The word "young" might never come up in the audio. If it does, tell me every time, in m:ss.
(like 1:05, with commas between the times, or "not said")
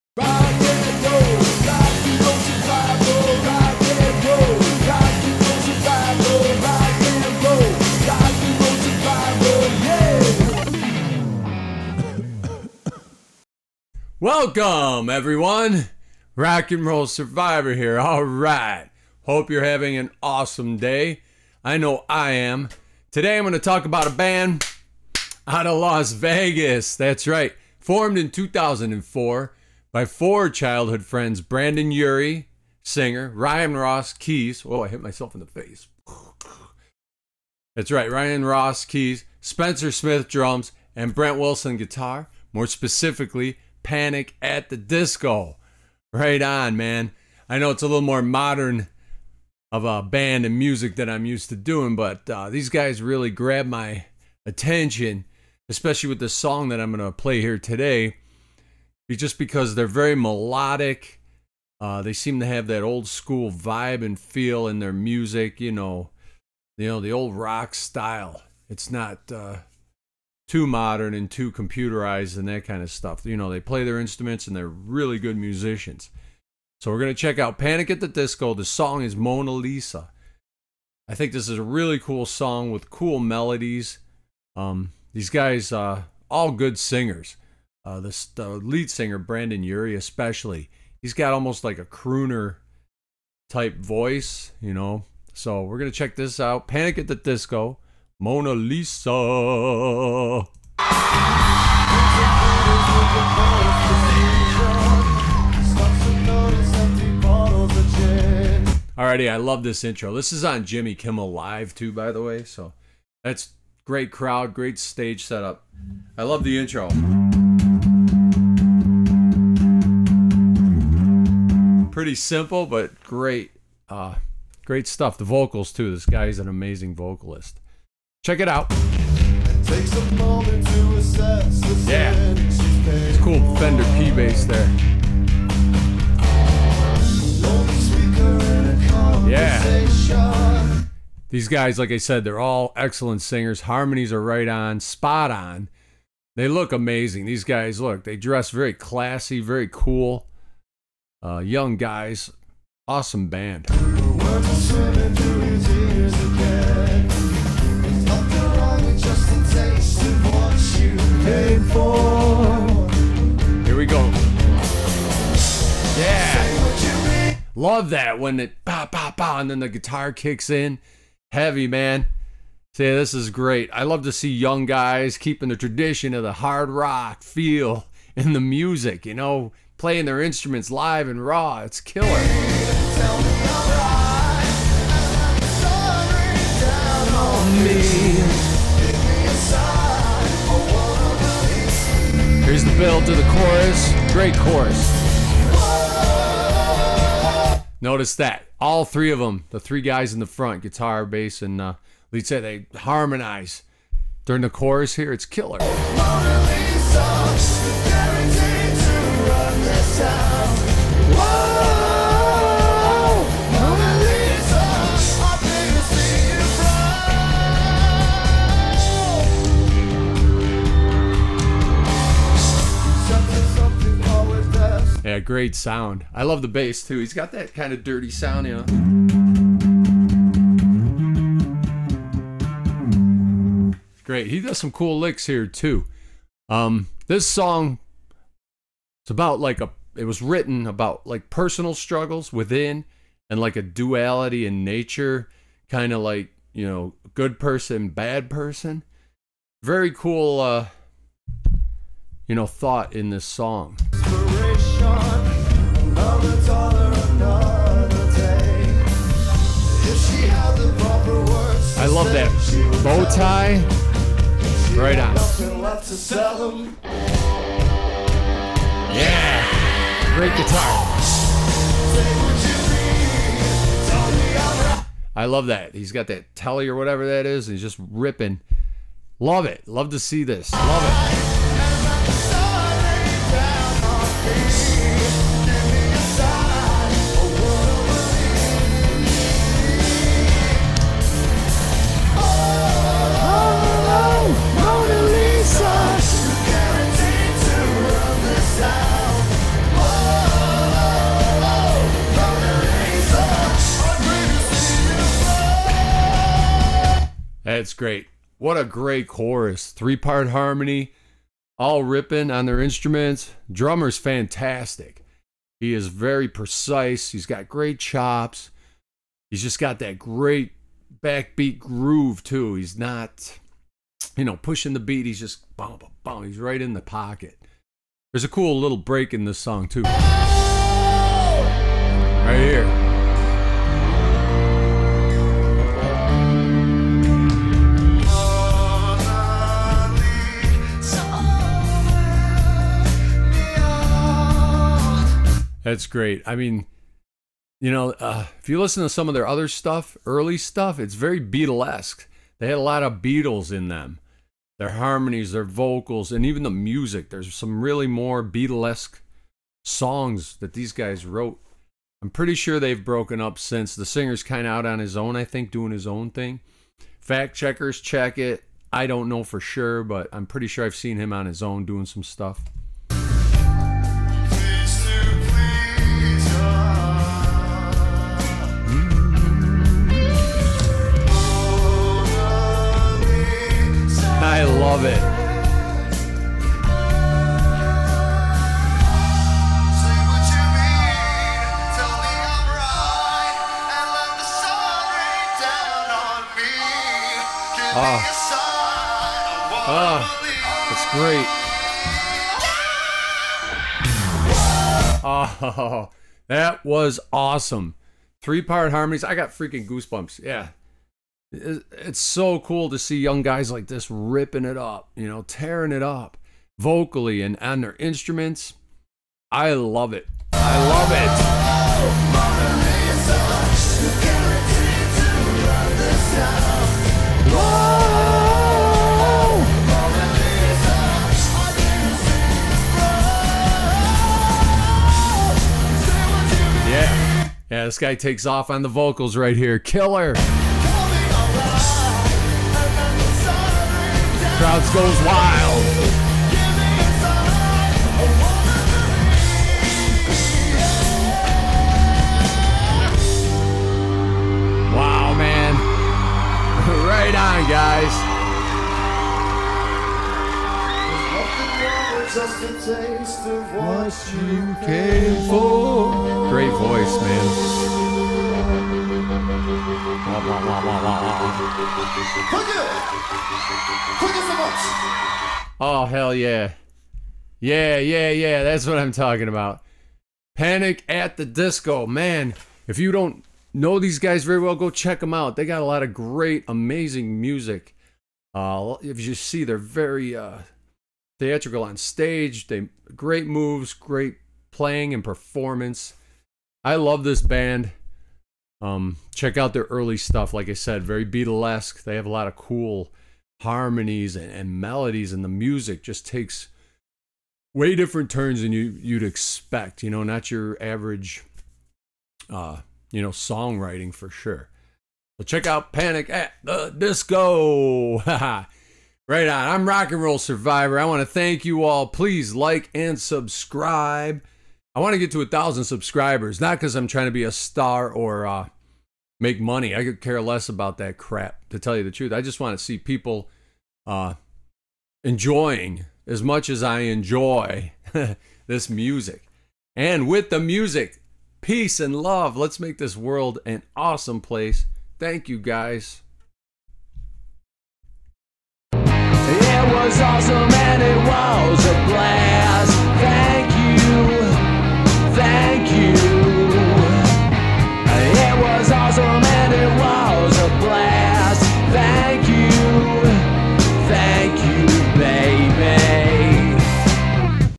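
2:31, 6:52.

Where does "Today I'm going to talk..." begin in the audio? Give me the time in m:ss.
0:23.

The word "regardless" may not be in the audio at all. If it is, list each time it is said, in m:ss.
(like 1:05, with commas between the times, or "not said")
not said.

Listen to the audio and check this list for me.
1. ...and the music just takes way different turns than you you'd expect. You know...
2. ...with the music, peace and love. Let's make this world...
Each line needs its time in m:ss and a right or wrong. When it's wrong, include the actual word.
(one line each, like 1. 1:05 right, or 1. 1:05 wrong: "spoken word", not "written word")
1. 8:25 right
2. 9:00 right.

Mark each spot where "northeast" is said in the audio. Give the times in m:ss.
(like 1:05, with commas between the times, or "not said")
not said.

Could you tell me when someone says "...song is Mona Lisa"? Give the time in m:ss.
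1:18.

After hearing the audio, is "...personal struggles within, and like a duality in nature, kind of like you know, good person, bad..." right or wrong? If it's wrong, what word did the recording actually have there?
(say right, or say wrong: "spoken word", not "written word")
right.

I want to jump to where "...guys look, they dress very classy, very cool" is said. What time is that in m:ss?
2:27.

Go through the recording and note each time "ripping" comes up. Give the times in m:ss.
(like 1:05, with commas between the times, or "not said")
4:37, 5:11, 6:53.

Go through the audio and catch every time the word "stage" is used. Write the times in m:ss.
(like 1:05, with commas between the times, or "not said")
1:54, 8:11.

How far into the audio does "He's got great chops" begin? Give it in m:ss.
5:17.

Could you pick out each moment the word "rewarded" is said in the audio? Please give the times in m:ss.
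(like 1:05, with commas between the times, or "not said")
not said.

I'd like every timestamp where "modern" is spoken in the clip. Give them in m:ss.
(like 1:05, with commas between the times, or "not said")
0:48, 1:10.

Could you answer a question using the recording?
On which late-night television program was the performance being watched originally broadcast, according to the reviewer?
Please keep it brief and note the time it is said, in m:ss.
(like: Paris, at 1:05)
Jimmy Kimmel Live, at 1:50.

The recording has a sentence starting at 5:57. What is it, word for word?
There's some really more Beatlesque songs that these guys wrote.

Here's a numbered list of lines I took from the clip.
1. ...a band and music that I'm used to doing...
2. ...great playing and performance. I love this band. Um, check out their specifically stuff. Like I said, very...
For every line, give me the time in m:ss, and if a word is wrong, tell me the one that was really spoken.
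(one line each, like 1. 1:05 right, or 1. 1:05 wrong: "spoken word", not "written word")
1. 0:49 right
2. 8:13 wrong: "early", not "specifically".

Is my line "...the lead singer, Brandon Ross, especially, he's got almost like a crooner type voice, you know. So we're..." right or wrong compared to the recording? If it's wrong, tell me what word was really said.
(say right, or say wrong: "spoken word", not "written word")
wrong: "Urie", not "Ross".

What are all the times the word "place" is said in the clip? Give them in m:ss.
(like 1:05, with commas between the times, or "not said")
9:04.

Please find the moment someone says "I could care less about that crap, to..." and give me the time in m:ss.
8:49.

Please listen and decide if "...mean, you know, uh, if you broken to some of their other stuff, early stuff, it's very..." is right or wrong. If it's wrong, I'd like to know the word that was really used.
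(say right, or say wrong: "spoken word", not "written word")
wrong: "listen", not "broken".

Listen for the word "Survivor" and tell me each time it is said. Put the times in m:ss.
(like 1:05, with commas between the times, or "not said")
0:17, 8:40.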